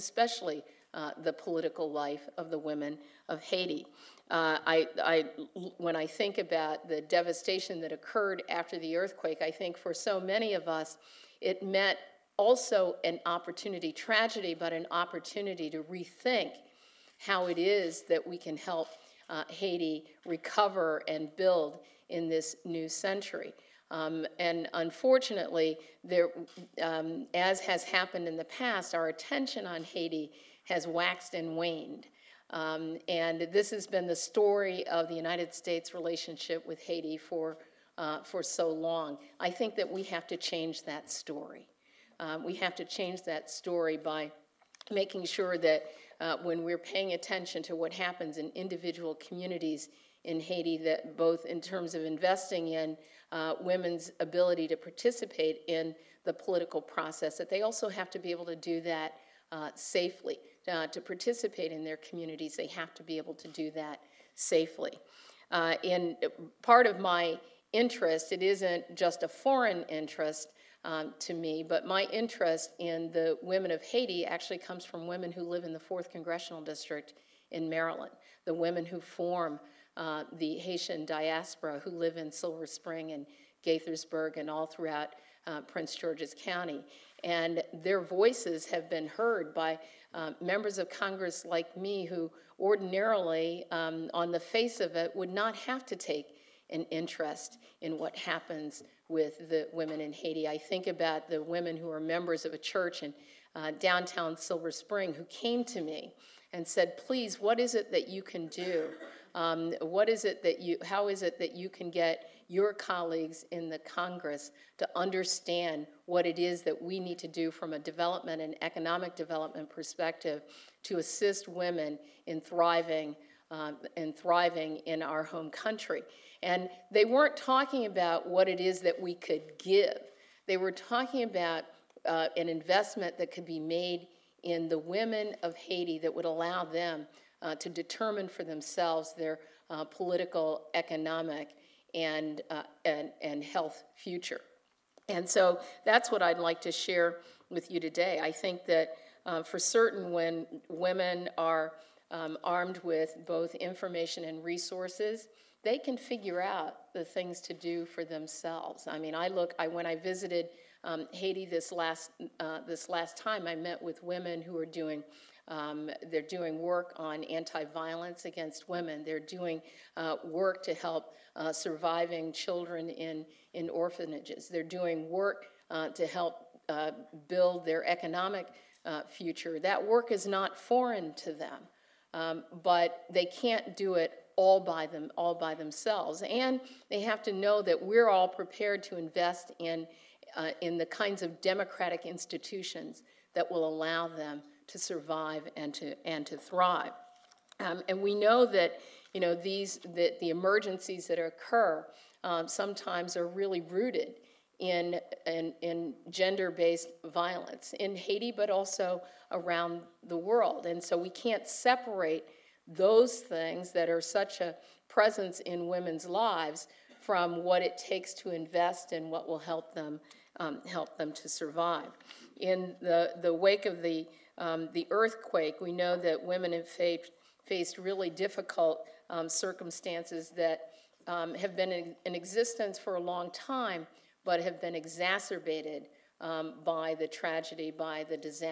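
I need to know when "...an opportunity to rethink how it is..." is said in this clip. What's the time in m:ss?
0:14.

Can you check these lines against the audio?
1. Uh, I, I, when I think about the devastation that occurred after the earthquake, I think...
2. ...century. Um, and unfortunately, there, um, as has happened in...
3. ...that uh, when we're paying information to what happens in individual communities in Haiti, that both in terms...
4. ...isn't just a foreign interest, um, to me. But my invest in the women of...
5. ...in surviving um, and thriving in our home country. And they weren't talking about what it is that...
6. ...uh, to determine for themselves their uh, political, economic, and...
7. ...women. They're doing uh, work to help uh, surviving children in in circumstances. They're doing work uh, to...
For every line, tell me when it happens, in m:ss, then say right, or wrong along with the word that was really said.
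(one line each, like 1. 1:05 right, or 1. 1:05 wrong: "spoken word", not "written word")
1. 0:04 right
2. 0:22 right
3. 0:45 wrong: "attention", not "information"
4. 1:08 wrong: "interest", not "invest"
5. 2:02 wrong: "thriving", not "surviving"
6. 2:17 right
7. 2:48 wrong: "orphanages", not "circumstances".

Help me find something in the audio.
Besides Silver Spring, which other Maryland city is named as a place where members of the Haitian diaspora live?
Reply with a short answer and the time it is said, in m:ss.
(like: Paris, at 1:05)
Gaithersburg, at 1:23.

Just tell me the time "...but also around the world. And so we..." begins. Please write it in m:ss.
3:28.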